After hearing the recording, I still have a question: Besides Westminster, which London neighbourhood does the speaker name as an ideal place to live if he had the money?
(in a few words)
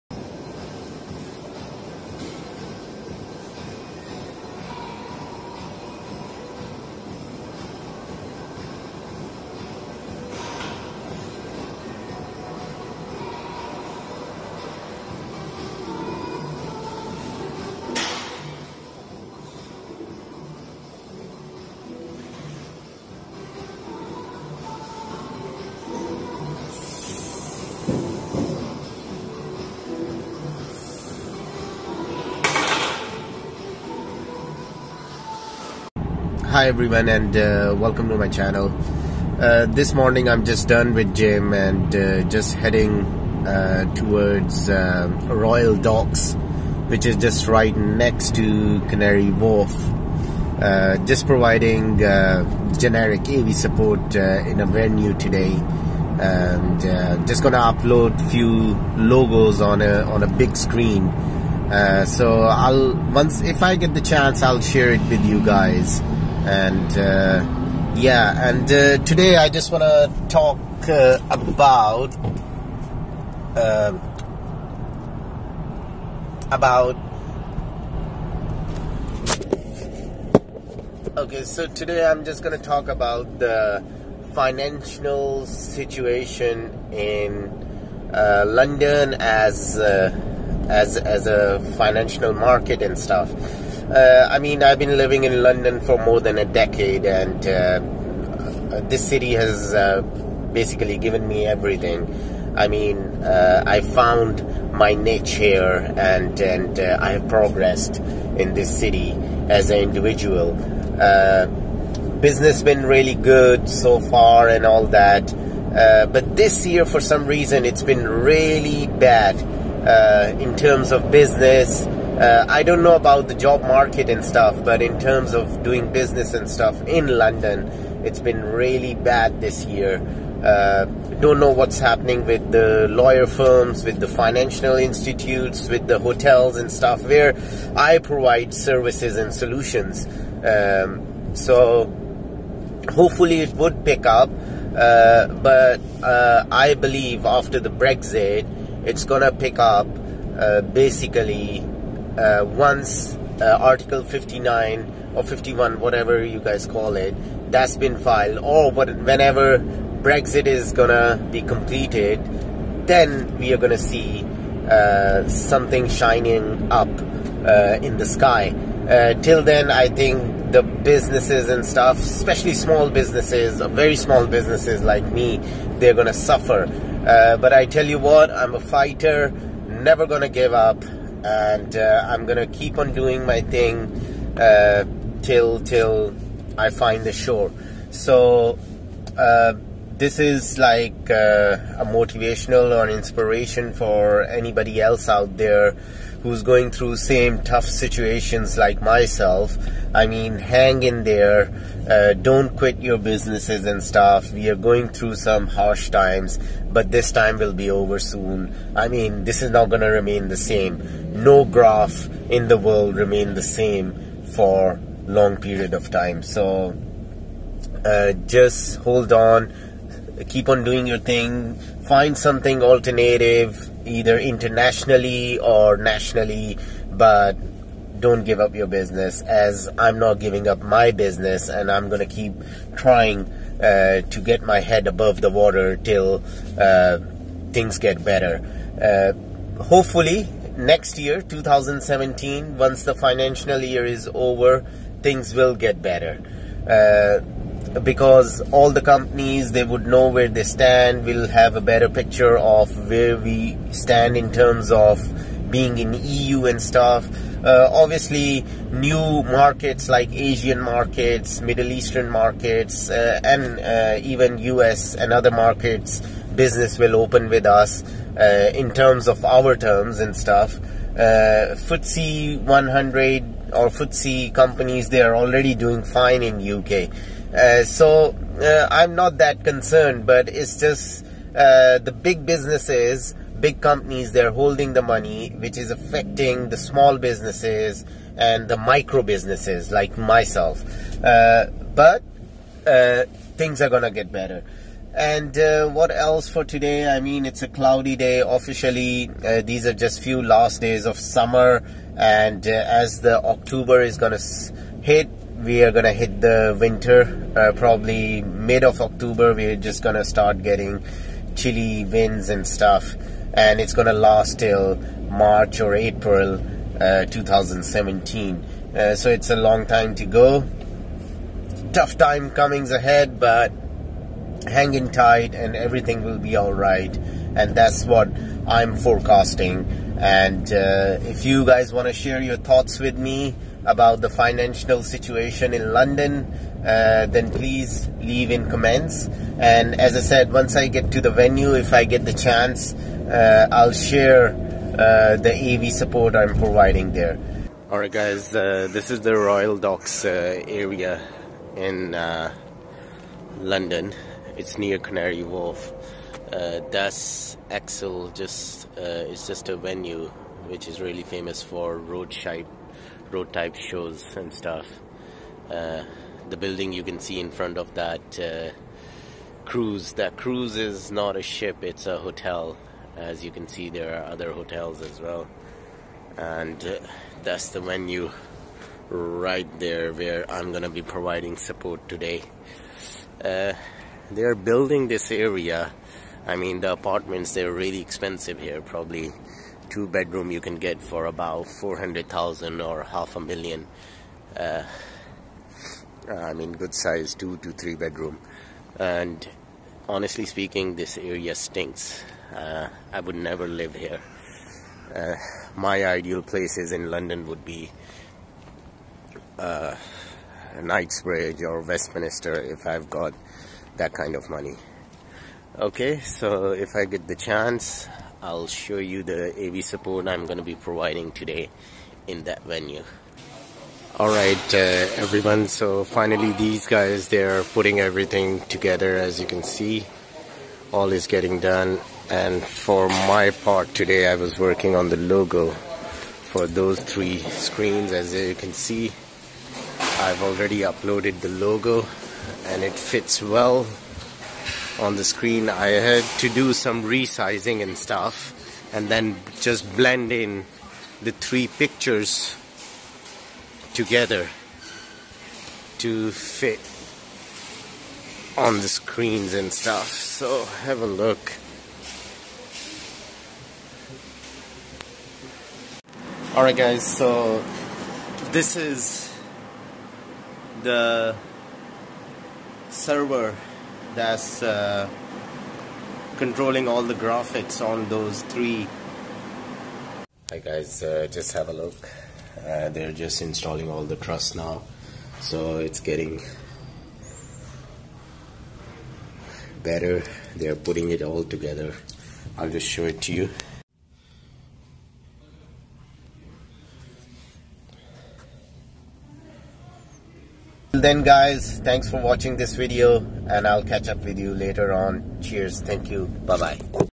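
Knightsbridge.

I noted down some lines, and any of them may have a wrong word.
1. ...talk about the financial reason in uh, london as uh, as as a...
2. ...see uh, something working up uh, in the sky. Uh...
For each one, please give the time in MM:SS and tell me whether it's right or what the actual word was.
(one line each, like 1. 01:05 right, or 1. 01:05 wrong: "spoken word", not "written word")
1. 01:22 wrong: "situation", not "reason"
2. 02:43 wrong: "shining", not "working".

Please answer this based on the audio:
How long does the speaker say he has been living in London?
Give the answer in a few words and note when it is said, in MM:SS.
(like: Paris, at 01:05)
more than a decade, at 01:35.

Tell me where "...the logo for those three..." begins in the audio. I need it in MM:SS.
07:14.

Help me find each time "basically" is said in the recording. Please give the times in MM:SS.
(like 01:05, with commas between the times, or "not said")
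01:40, 02:30.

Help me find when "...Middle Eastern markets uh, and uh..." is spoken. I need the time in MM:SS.
04:21.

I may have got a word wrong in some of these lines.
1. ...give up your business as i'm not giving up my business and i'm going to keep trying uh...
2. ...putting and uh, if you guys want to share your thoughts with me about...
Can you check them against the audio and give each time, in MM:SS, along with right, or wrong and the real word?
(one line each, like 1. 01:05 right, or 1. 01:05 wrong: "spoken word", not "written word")
1. 03:48 right
2. 05:28 wrong: "forecasting", not "putting".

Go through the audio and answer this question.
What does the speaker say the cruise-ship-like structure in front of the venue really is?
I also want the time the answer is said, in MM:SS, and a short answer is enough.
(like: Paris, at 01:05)
a hotel, at 06:11.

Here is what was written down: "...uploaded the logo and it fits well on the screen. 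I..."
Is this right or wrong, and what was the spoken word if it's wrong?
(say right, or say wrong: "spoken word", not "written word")
right.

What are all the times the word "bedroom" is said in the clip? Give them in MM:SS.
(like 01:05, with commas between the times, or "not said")
06:29, 06:37.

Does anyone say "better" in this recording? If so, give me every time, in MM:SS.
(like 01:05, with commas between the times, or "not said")
03:58, 04:05, 04:11, 04:54, 08:09.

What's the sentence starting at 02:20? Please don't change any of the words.
Um, so hopefully it would pick up.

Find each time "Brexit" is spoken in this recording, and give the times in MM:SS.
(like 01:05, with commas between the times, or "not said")
02:27, 02:39.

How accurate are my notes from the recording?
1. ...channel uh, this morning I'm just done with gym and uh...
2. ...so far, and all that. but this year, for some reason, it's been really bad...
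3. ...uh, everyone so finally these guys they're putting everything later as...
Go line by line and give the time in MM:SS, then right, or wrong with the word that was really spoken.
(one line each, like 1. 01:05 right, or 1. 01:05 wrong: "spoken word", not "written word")
1. 00:38 right
2. 01:53 right
3. 07:04 wrong: "together", not "later".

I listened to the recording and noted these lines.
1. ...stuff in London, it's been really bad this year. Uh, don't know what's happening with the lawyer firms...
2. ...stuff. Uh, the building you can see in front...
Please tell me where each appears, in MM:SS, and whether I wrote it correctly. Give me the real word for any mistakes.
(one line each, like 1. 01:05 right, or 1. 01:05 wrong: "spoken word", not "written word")
1. 02:06 right
2. 06:04 right.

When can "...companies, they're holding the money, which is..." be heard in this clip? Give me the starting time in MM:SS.
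04:43.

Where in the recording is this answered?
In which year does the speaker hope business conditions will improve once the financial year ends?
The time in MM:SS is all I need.
04:00.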